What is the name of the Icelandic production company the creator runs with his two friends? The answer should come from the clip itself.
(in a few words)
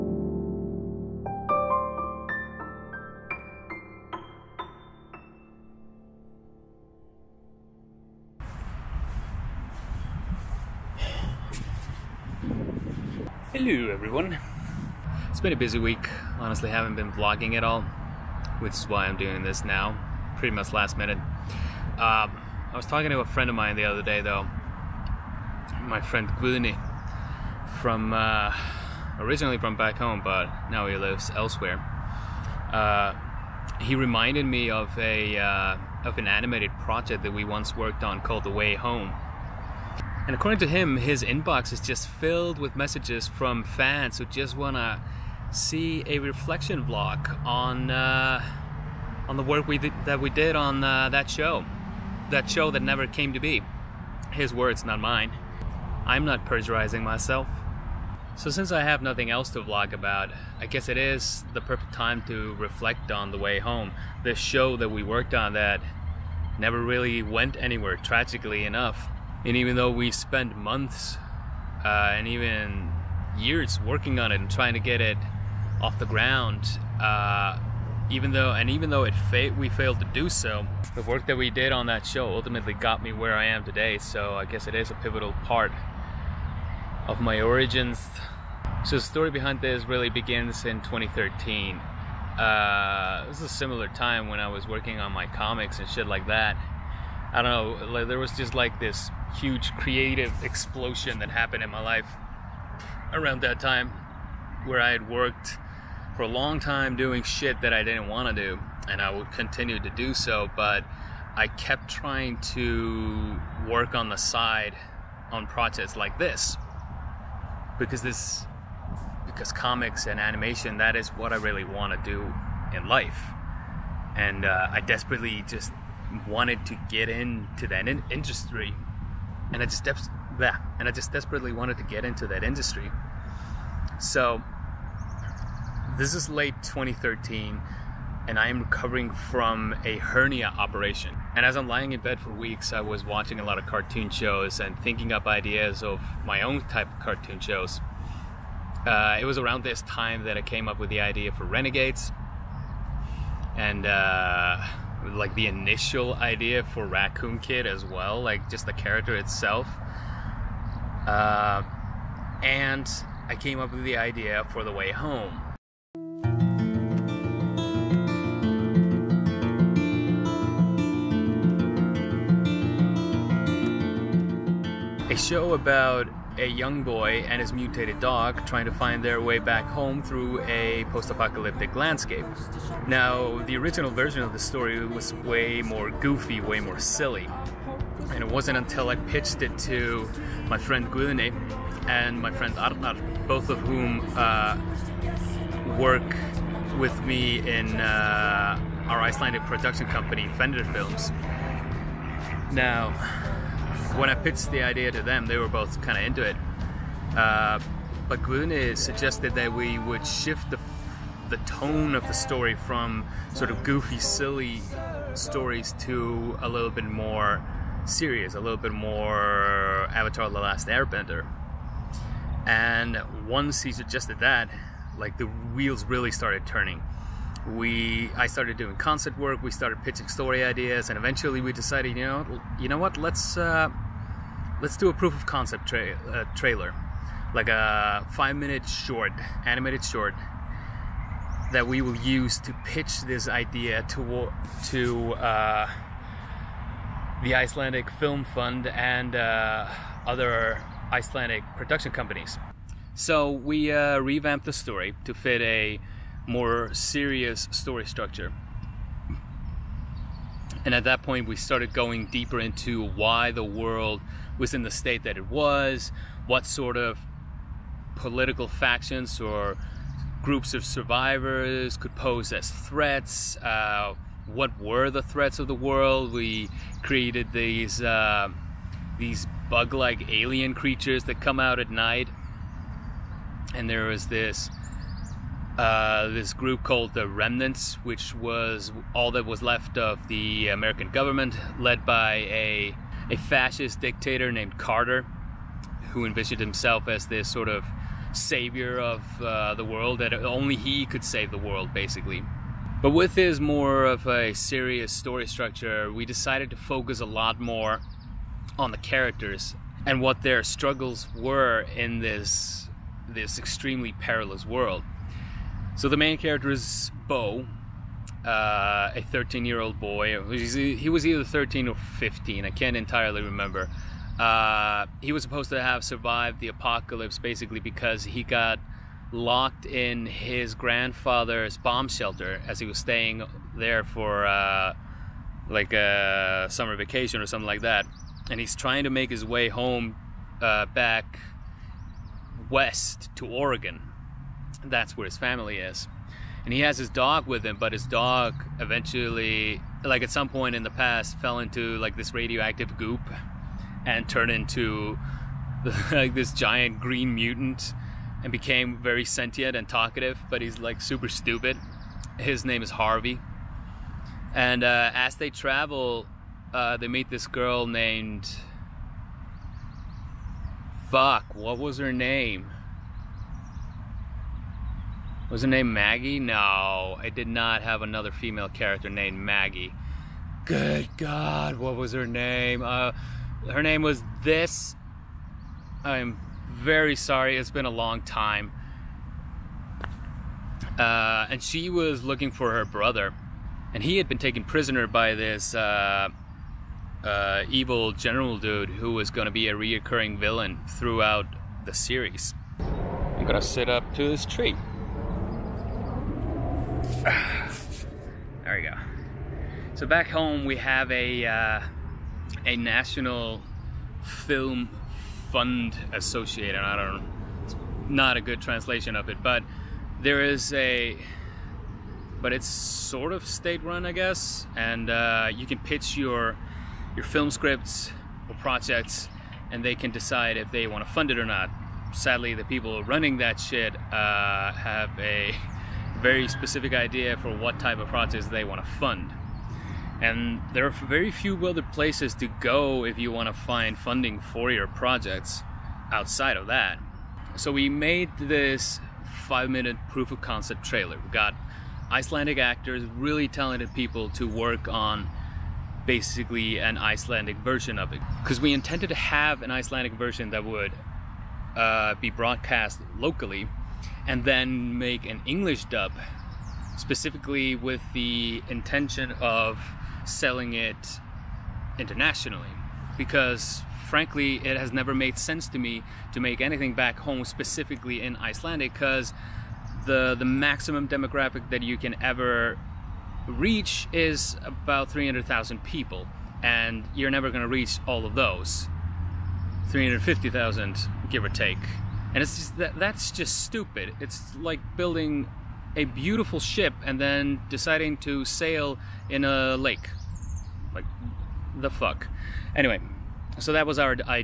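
Fender Films.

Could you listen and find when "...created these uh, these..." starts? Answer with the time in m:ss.
4:36.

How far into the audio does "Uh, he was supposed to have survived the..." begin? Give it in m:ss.
5:24.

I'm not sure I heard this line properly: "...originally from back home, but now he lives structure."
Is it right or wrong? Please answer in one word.
wrong.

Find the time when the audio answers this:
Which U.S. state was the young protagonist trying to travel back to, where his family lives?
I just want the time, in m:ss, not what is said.
5:43.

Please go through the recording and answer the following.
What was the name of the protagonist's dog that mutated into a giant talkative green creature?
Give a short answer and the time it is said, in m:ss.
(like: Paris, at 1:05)
Harvey, at 6:02.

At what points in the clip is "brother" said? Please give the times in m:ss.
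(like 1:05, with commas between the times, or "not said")
6:32.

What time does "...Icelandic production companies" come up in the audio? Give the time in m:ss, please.
4:10.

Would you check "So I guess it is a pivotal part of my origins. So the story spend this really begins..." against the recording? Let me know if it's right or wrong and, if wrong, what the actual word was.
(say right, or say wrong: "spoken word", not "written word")
wrong: "behind", not "spend".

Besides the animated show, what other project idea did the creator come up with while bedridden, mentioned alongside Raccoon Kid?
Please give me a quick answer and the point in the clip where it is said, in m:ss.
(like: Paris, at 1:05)
Renegades, at 2:31.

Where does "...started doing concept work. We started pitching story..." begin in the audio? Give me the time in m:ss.
3:48.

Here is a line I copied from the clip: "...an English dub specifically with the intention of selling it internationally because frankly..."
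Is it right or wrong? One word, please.
right.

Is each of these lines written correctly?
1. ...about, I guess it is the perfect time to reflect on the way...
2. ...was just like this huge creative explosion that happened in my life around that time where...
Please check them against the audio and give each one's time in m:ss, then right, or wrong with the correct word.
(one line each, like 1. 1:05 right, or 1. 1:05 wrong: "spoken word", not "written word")
1. 0:59 right
2. 1:38 right.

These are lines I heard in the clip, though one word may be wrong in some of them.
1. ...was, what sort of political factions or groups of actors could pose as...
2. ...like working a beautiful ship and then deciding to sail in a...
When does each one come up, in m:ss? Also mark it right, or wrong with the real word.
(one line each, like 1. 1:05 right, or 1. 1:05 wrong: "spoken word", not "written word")
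1. 4:25 wrong: "survivors", not "actors"
2. 8:14 wrong: "building", not "working".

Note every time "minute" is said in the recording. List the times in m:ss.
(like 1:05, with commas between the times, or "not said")
0:20, 3:58, 7:29.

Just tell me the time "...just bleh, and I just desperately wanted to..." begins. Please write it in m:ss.
2:09.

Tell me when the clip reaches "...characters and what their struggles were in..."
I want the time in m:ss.
5:08.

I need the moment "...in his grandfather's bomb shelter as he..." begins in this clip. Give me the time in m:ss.
5:29.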